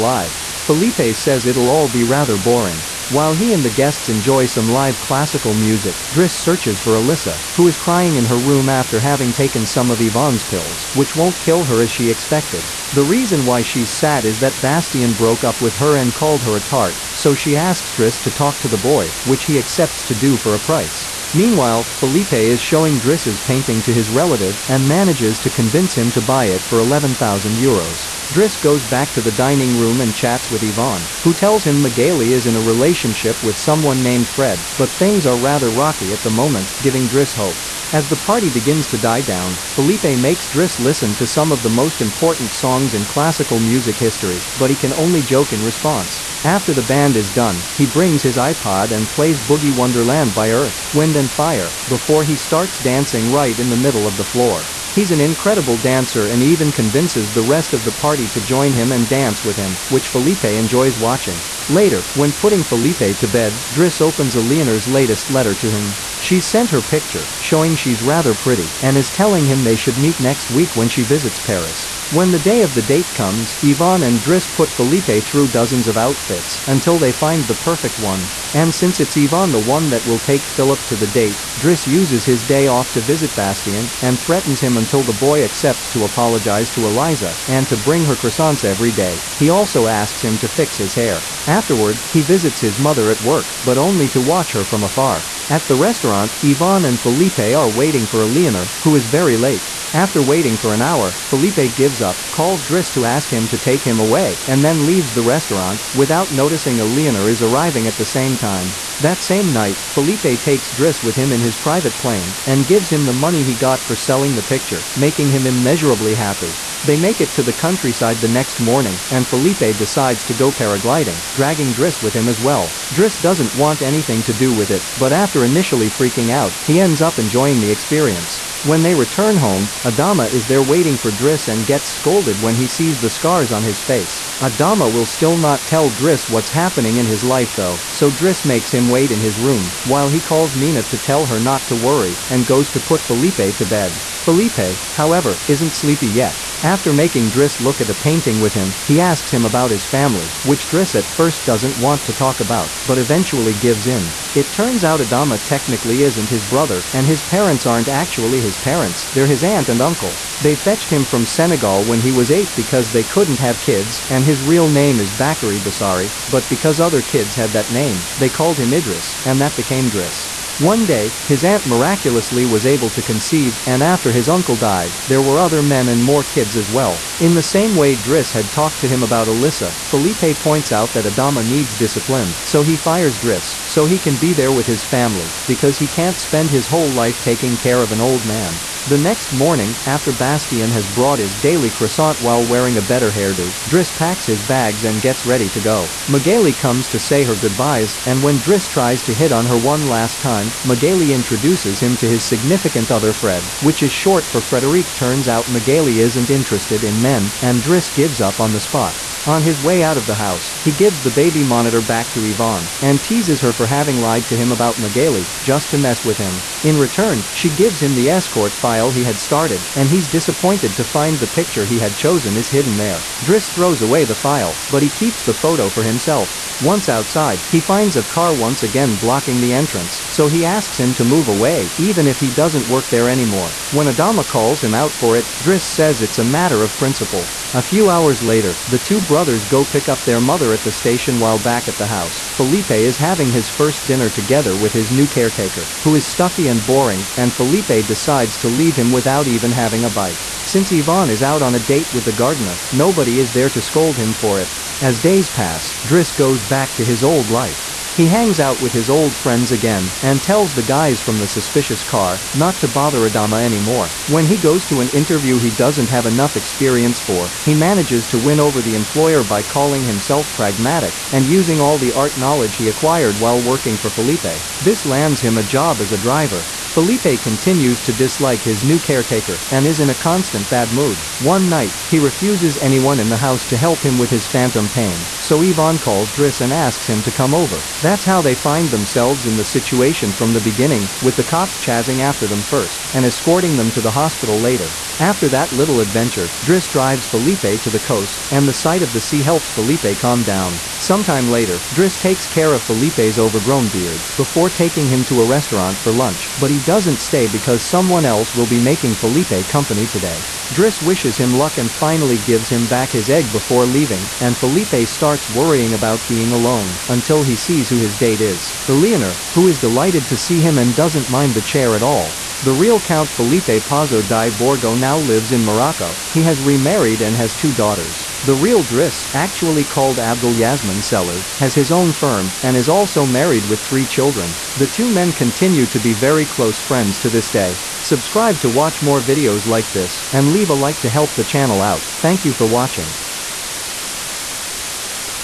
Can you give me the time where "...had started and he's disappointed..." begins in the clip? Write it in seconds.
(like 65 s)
219 s.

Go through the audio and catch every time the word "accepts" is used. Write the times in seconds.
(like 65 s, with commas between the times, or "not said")
19 s, 85 s.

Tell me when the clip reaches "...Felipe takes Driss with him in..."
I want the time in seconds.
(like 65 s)
109 s.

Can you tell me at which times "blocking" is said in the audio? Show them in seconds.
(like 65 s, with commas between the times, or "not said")
228 s.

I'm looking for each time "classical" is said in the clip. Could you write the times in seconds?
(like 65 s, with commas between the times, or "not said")
4 s, 43 s.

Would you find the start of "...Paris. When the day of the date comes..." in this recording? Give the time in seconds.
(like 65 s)
71 s.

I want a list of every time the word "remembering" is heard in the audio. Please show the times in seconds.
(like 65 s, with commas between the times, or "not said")
not said.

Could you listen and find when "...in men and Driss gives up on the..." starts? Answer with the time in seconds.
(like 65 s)
206 s.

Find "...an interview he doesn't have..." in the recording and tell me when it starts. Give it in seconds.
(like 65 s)
264 s.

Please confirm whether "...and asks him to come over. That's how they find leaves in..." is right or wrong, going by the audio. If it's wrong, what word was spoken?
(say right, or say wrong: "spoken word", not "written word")
wrong: "themselves", not "leaves".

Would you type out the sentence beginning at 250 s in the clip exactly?
Since Yvonne is out on a date with the gardener, nobody is there to scold him for it.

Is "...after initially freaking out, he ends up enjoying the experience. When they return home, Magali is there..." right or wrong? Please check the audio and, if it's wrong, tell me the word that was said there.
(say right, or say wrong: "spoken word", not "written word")
wrong: "Adama", not "Magali".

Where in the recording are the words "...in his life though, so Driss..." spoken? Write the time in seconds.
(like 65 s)
136 s.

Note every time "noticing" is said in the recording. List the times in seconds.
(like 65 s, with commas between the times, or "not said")
106 s.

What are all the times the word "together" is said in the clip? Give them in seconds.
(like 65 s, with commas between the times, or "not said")
244 s.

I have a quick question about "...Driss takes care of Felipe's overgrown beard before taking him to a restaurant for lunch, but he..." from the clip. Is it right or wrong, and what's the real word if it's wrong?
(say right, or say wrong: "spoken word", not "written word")
right.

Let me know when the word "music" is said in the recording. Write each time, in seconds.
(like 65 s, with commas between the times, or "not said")
5 s, 43 s.